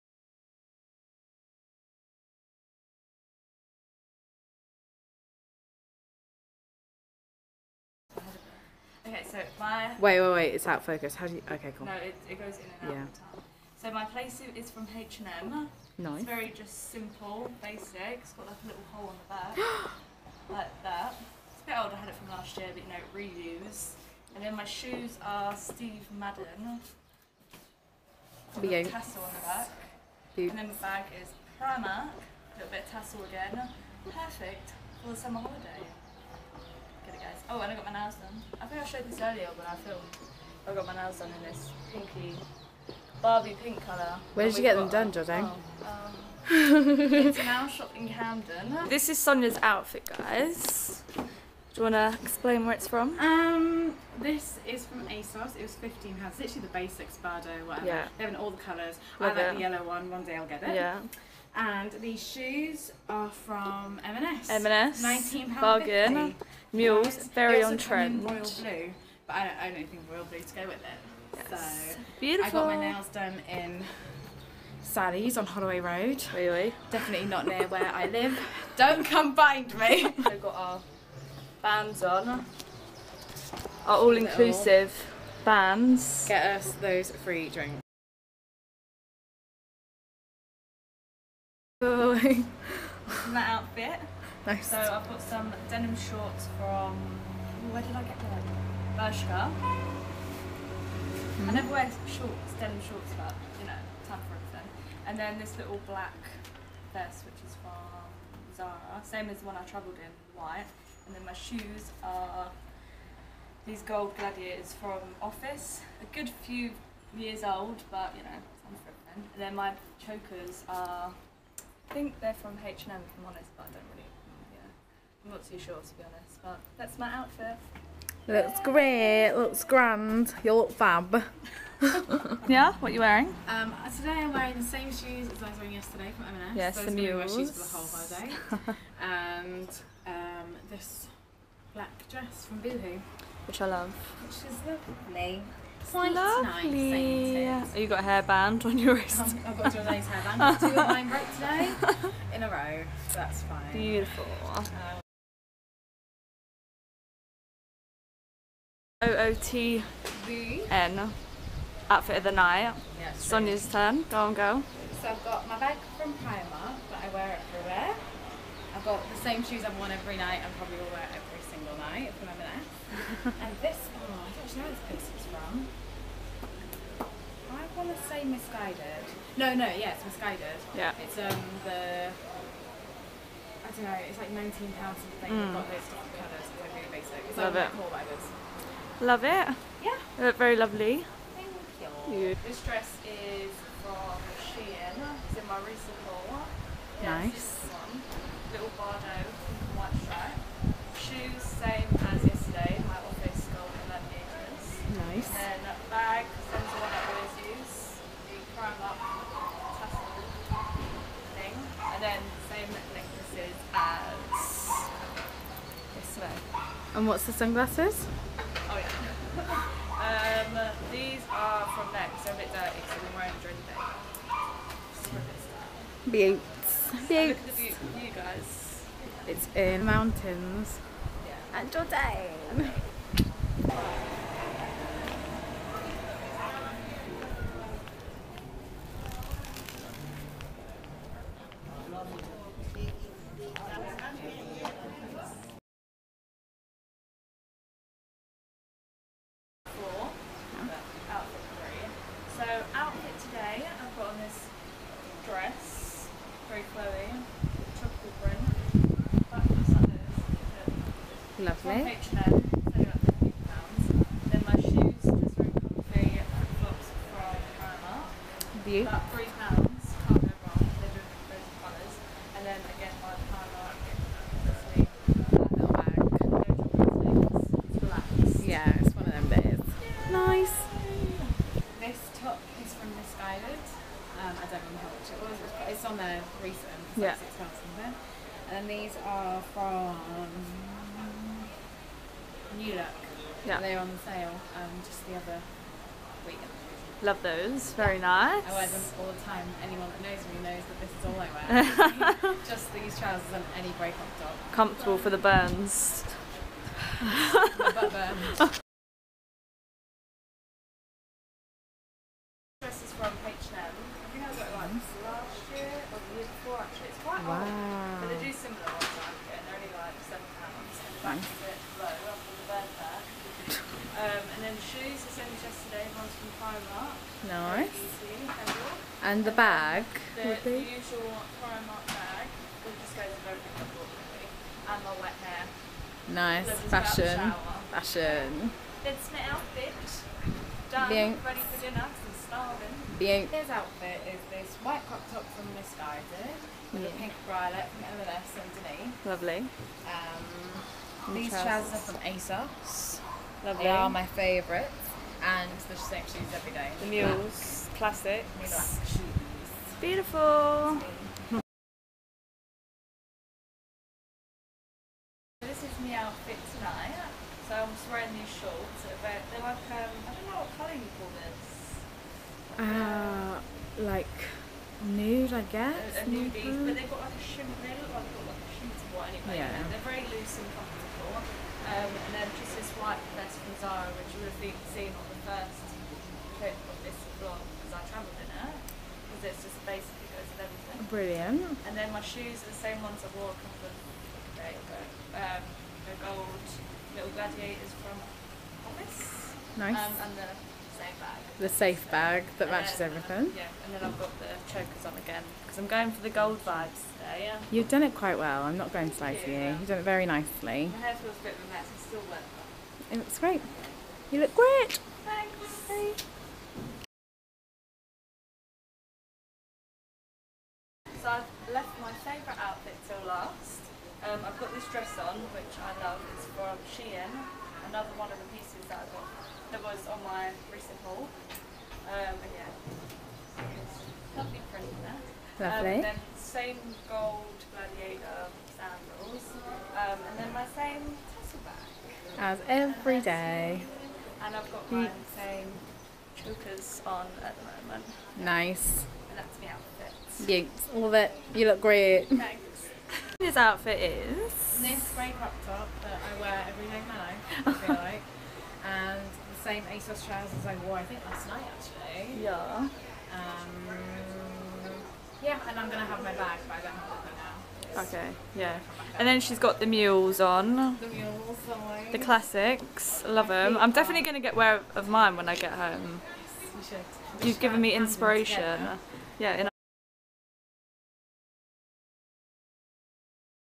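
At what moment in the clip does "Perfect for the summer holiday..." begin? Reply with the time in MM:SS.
00:34.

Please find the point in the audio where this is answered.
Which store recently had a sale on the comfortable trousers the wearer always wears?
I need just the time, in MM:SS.
04:52.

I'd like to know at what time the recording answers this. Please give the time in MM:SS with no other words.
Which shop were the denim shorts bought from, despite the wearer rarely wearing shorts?
01:38.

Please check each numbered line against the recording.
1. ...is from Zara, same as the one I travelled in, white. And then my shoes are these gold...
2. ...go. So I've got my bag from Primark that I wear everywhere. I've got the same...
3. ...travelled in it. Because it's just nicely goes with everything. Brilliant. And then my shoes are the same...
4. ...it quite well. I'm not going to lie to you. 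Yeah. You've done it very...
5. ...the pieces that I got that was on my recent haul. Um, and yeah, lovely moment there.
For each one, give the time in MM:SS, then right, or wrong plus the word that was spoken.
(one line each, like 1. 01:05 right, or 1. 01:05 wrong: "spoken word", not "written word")
1. 01:47 right
2. 02:44 right
3. 06:27 wrong: "basically", not "nicely"
4. 06:47 right
5. 07:08 wrong: "print", not "moment".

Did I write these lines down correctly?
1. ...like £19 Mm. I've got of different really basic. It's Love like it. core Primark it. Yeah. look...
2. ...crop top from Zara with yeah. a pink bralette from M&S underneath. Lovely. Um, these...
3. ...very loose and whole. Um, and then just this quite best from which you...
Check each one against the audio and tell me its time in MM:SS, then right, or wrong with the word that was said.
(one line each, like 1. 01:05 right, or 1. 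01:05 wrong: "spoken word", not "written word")
1. 03:04 wrong: "Love", not "Primark"
2. 05:44 wrong: "Missguided", not "Zara"
3. 06:19 wrong: "comfortable", not "whole".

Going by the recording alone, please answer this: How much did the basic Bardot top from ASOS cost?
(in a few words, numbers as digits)
£15.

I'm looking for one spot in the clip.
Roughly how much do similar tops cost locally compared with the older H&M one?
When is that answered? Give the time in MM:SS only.
05:21.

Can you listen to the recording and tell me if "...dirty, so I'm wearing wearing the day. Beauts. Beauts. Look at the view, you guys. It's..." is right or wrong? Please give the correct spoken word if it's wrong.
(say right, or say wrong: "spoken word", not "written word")
wrong: "during", not "wearing".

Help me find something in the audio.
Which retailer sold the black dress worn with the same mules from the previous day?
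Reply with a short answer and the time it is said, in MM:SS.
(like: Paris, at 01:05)
Boohoo, at 02:22.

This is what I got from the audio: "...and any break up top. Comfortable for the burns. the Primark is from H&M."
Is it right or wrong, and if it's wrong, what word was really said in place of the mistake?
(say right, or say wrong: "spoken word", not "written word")
wrong: "This", not "Primark".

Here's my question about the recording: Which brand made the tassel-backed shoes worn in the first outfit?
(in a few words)
Steve Madden.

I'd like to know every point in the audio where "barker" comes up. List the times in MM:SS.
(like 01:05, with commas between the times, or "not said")
not said.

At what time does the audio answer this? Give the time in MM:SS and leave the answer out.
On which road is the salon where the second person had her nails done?
01:15.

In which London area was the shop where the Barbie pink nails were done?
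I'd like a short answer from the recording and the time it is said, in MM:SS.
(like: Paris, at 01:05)
Camden, at 00:48.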